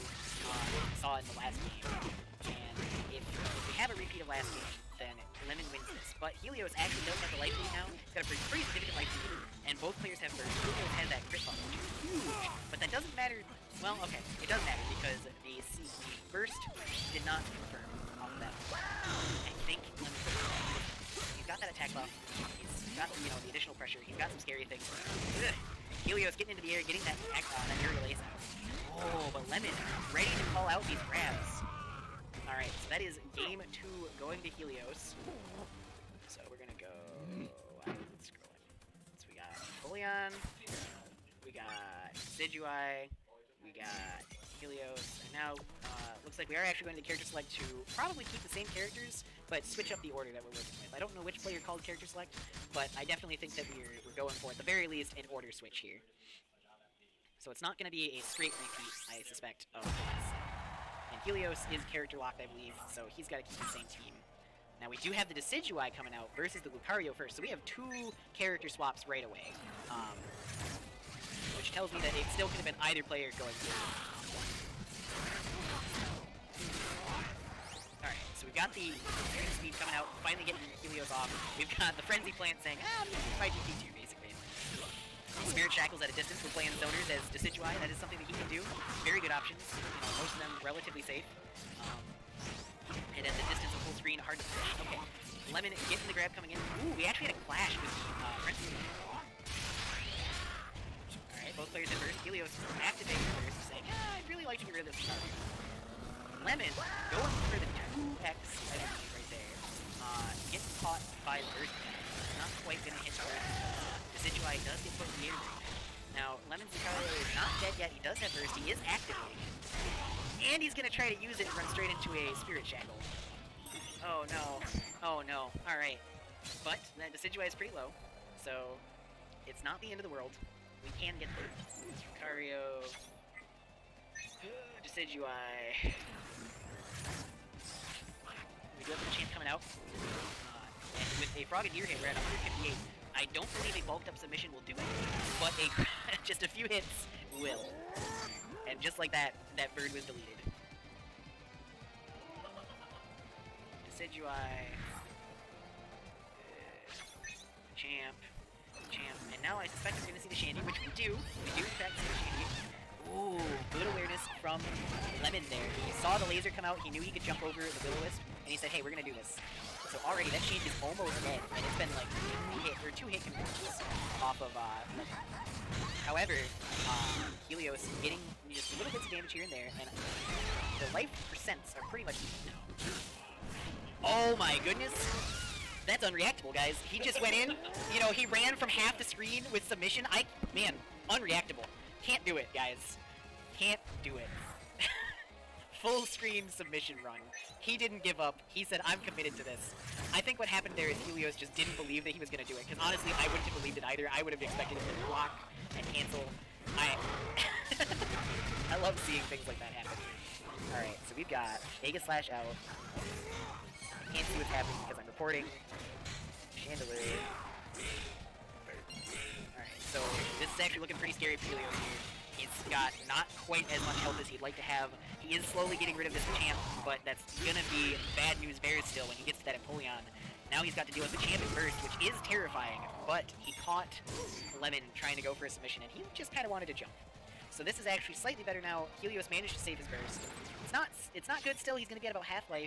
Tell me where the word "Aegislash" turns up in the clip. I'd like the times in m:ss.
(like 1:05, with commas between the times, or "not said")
3:31.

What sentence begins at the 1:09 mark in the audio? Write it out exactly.
Um, which tells me that it still could have been either player going through.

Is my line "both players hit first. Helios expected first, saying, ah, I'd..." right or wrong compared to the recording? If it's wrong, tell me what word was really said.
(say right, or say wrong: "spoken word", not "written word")
wrong: "activated", not "expected".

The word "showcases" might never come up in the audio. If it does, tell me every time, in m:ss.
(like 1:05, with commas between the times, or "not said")
not said.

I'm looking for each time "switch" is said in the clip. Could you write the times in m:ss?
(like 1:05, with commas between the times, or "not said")
0:49, 0:55.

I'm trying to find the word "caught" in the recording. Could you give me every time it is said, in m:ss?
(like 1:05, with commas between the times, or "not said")
1:50, 3:53.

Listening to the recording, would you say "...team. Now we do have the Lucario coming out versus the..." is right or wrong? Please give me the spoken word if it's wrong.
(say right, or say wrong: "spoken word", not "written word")
wrong: "Decidueye", not "Lucario".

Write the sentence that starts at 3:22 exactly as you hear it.
Because honestly, I wouldn't have believed it either.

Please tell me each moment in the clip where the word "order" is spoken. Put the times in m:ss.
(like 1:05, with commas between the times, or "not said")
0:50, 0:55.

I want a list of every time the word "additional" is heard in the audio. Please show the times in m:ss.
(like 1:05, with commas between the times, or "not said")
0:23.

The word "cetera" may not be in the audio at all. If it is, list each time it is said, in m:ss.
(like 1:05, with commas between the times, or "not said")
not said.